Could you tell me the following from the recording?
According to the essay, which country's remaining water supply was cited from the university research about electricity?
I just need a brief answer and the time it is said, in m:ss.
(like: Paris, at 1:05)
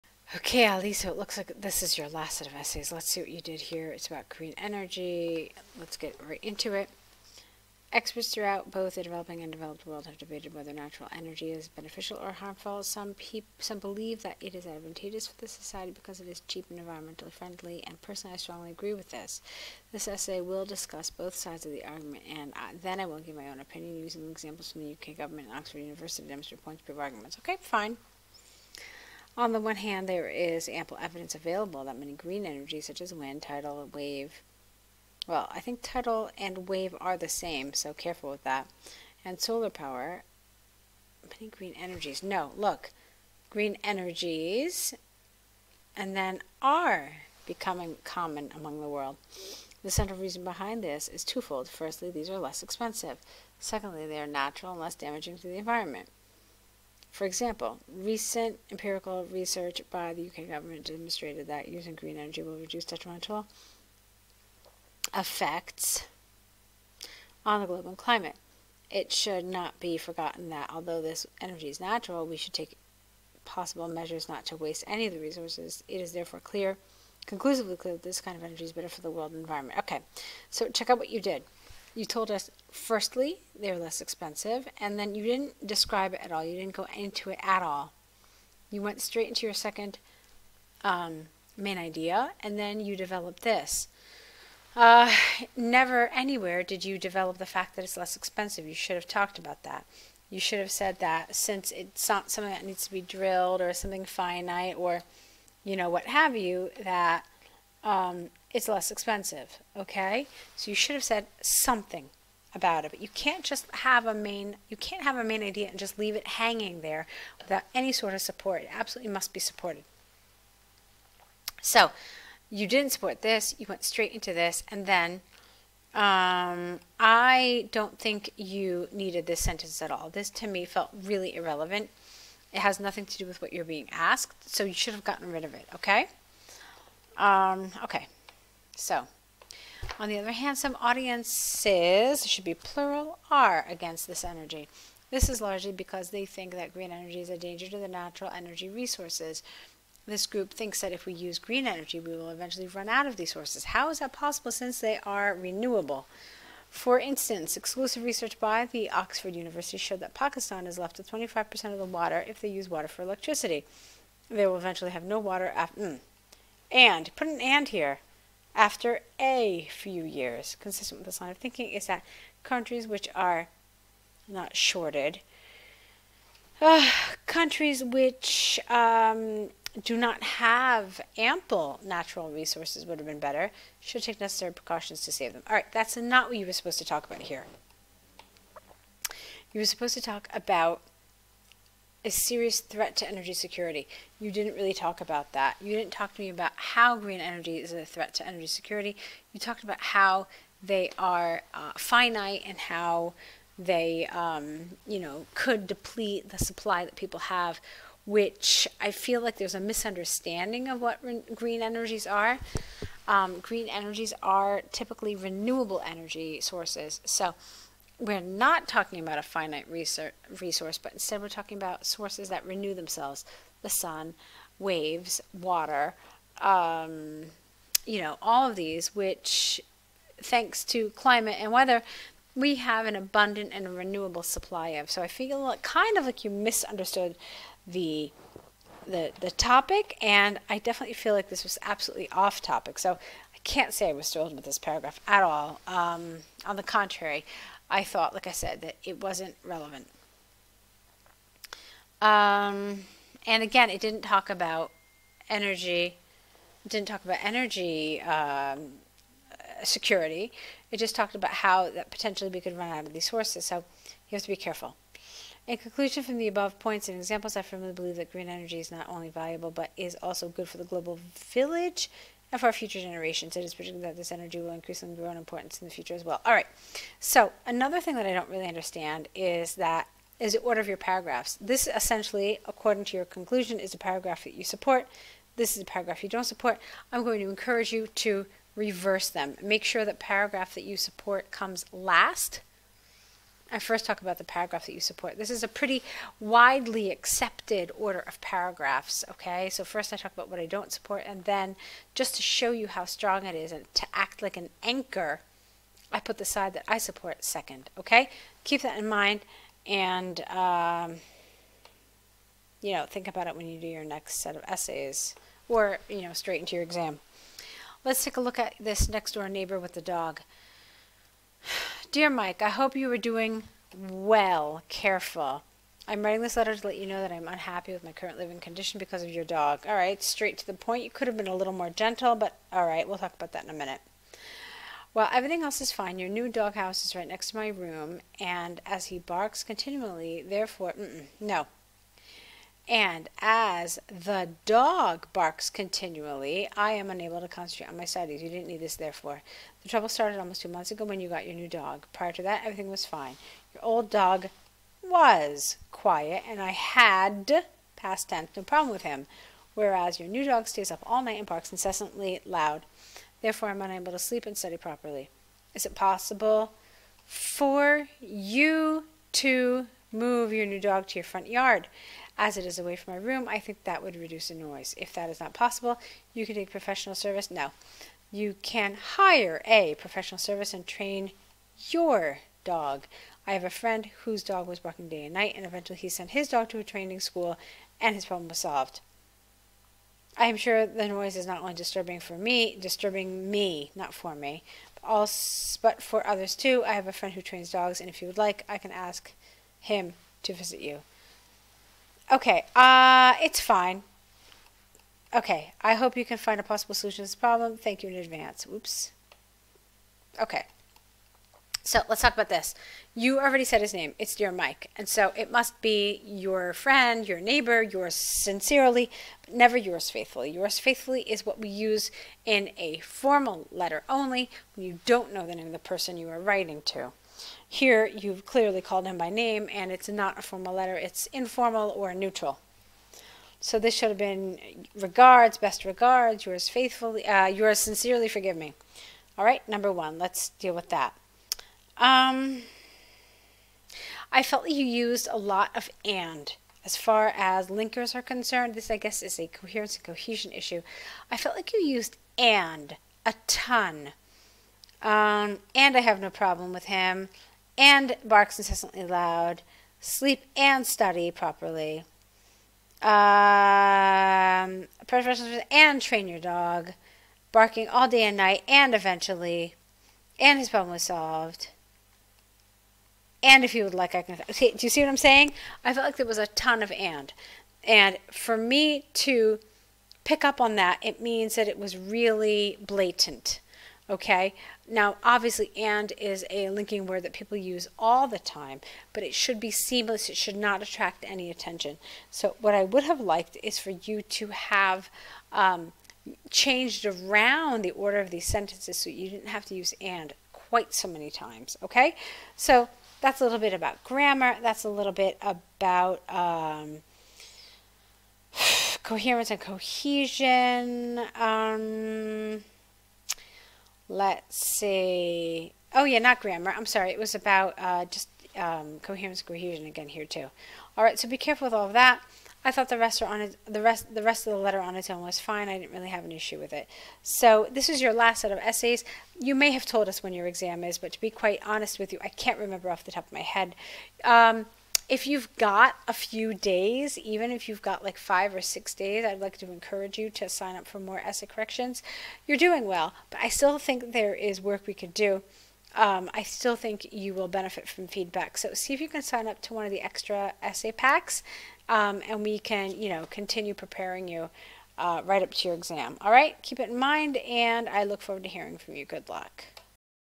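Pakistan, at 2:40.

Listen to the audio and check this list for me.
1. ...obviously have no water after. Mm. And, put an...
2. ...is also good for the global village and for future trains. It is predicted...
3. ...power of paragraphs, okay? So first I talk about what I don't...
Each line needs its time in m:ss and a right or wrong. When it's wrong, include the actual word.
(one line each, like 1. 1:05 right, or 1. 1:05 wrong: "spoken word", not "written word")
1. 2:44 wrong: "eventually", not "obviously"
2. 4:29 wrong: "generations", not "trains"
3. 4:57 wrong: "order", not "power".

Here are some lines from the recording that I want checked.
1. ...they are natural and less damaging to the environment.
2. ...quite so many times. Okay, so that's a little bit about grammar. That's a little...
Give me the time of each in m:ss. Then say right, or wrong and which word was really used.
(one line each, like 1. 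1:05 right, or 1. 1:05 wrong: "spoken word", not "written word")
1. 0:54 right
2. 8:20 right.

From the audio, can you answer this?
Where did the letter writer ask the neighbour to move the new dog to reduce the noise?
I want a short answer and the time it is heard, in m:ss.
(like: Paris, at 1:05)
front yard, at 6:11.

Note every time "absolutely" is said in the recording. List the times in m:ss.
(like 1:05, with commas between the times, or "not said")
1:58, 4:01.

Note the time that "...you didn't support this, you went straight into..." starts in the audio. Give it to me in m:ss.
2:02.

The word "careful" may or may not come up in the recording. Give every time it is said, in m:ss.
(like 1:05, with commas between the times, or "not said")
0:37, 4:24, 5:24, 8:41.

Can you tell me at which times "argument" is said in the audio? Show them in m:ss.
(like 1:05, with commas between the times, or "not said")
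0:21, 0:26.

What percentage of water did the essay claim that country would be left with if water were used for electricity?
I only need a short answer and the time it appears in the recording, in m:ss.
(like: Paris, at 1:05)
25%, at 2:41.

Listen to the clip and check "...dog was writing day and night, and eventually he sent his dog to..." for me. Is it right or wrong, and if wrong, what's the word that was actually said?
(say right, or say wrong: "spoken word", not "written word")
wrong: "barking", not "writing".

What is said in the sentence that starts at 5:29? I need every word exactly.
All right, straight to the point.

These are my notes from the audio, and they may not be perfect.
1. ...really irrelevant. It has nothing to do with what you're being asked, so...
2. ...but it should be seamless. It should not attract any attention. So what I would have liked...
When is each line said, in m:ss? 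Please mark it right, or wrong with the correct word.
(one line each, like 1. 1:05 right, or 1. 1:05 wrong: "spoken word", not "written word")
1. 2:11 right
2. 8:08 right.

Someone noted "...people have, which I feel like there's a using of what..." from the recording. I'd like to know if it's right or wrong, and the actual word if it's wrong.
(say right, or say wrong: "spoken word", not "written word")
wrong: "misunderstanding", not "using".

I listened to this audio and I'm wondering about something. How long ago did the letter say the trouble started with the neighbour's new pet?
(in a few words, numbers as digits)
two months.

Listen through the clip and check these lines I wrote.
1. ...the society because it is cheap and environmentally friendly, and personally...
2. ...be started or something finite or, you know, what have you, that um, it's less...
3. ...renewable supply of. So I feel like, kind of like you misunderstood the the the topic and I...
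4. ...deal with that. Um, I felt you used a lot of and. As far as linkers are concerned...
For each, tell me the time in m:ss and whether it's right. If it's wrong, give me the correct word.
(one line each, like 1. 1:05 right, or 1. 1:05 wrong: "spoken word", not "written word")
1. 0:15 right
2. 1:42 wrong: "drilled", not "started"
3. 3:53 right
4. 7:20 right.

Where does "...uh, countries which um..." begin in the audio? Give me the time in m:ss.
2:56.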